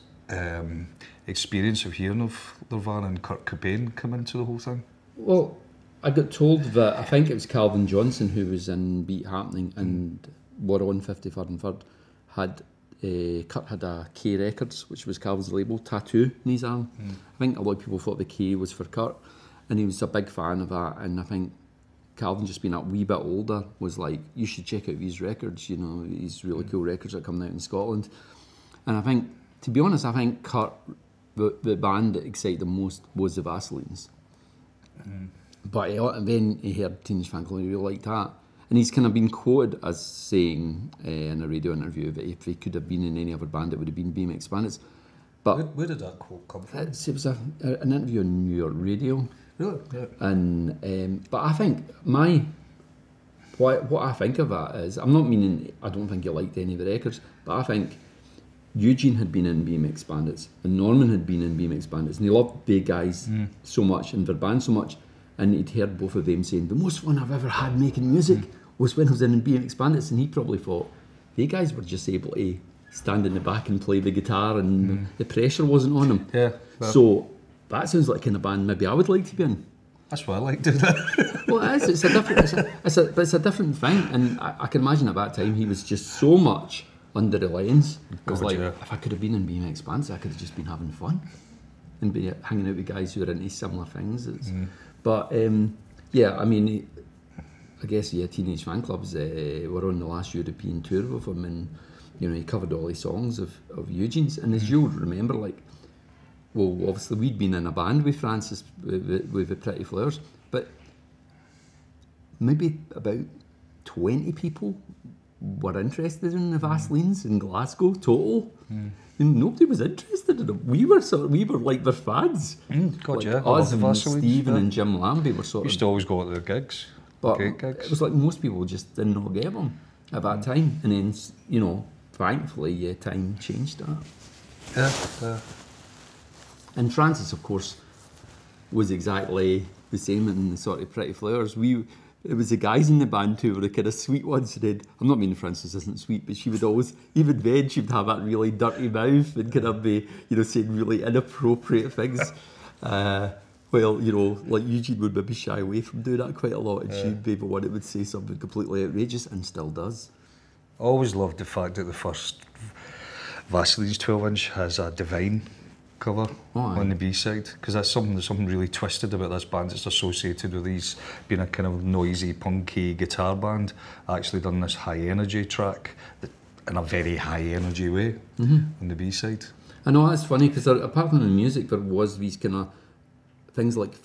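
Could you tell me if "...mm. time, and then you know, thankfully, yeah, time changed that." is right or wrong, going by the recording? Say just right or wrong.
right.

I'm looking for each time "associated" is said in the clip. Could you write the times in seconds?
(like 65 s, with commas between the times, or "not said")
169 s.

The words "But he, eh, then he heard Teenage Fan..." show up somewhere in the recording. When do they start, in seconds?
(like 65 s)
35 s.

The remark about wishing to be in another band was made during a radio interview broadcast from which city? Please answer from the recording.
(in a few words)
New York.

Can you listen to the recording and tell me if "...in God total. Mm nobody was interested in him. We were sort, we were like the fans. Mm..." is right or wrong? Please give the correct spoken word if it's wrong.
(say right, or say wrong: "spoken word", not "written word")
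wrong: "Glasgow", not "God".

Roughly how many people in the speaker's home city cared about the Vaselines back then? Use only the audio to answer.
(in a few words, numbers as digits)
about 20.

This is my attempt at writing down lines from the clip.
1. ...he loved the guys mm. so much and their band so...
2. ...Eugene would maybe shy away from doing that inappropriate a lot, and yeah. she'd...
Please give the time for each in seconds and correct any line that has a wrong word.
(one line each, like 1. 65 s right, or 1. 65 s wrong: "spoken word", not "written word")
1. 62 s right
2. 154 s wrong: "quite", not "inappropriate".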